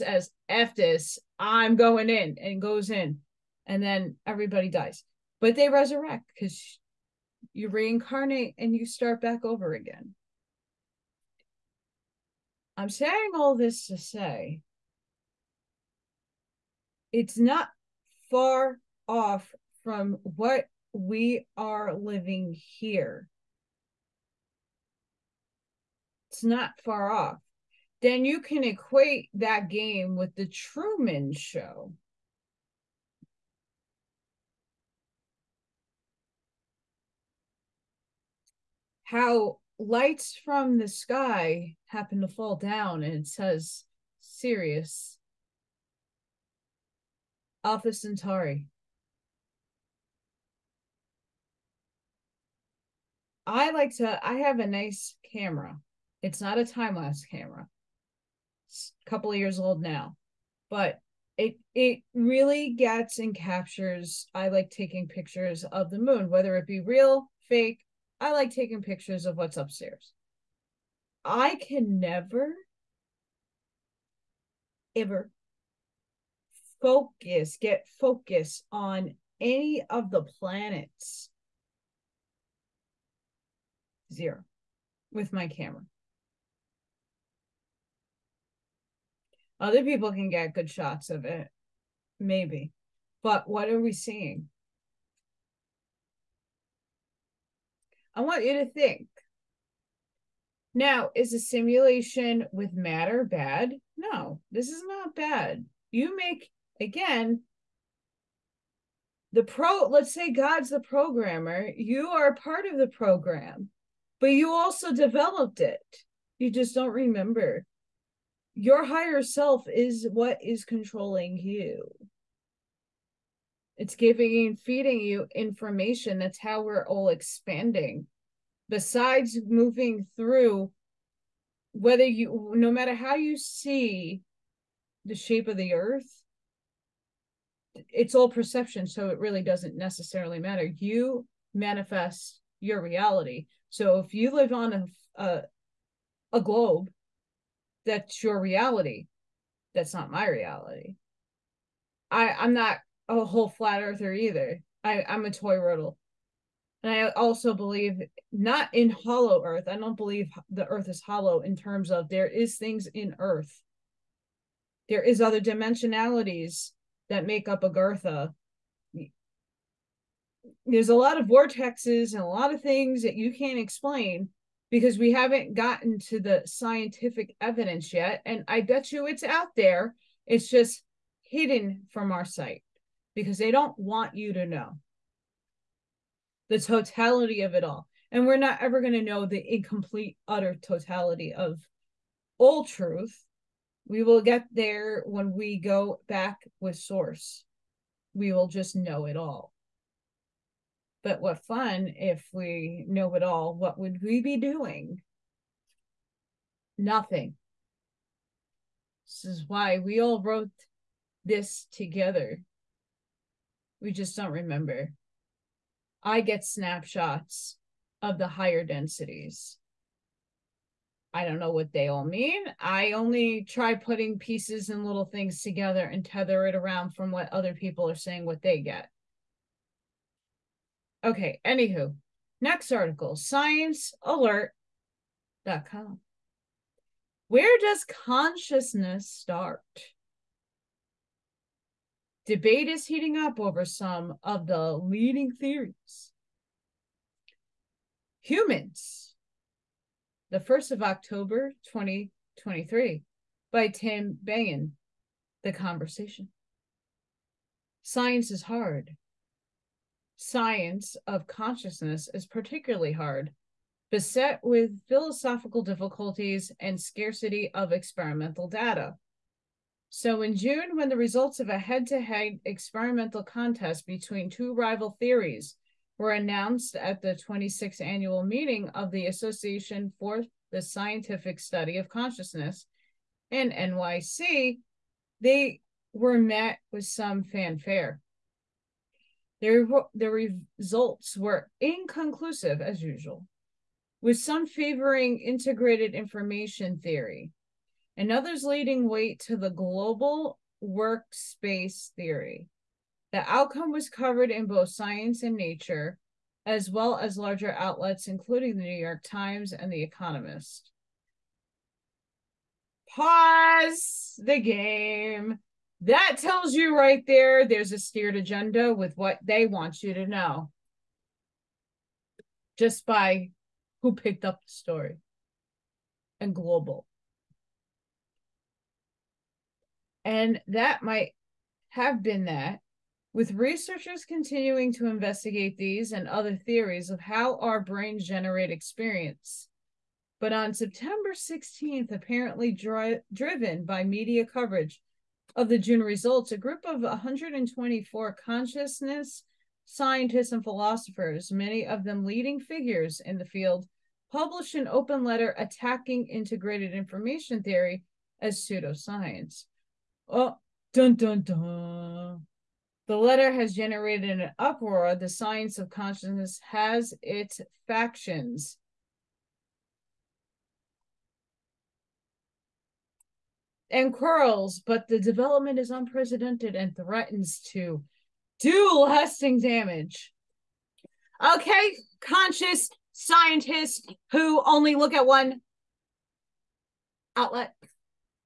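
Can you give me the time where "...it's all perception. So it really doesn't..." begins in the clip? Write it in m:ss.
2:17.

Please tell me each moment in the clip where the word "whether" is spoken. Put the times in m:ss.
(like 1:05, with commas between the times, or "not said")
1:06, 2:11.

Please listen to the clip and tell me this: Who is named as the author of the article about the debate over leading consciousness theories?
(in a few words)
Tim Bayne.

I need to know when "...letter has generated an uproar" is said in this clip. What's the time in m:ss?
6:02.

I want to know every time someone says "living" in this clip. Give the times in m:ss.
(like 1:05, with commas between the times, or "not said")
0:21.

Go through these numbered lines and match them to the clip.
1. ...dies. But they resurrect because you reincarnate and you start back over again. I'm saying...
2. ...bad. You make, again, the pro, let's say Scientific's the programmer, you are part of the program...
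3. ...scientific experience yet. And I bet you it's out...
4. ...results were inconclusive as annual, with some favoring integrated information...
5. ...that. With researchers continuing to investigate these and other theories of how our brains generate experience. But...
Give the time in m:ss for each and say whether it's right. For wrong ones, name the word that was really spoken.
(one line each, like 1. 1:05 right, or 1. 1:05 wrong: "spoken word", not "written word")
1. 0:04 right
2. 1:45 wrong: "God", not "Scientific"
3. 2:56 wrong: "evidence", not "experience"
4. 4:50 wrong: "usual", not "annual"
5. 5:32 right.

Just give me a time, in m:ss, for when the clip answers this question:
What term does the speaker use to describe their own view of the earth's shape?
2:35.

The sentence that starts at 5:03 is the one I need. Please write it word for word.
The outcome was covered in both science and nature, as well as larger outlets, including the New York Times and The Economist.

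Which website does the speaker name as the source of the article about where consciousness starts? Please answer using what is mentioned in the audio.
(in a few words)
sciencealert.com.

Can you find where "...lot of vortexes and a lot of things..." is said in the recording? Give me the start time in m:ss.
2:50.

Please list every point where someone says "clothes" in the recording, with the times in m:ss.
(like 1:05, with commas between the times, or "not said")
not said.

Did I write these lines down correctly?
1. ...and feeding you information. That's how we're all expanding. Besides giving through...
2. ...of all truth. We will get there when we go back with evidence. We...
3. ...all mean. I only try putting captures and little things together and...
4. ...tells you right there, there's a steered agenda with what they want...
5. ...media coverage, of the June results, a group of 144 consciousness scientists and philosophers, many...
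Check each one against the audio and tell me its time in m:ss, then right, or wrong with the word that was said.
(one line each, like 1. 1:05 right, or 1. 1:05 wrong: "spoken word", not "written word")
1. 2:04 wrong: "moving", not "giving"
2. 3:11 wrong: "source", not "evidence"
3. 3:41 wrong: "pieces", not "captures"
4. 5:16 right
5. 5:43 wrong: "124", not "144".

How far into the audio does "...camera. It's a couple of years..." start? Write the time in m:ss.
0:57.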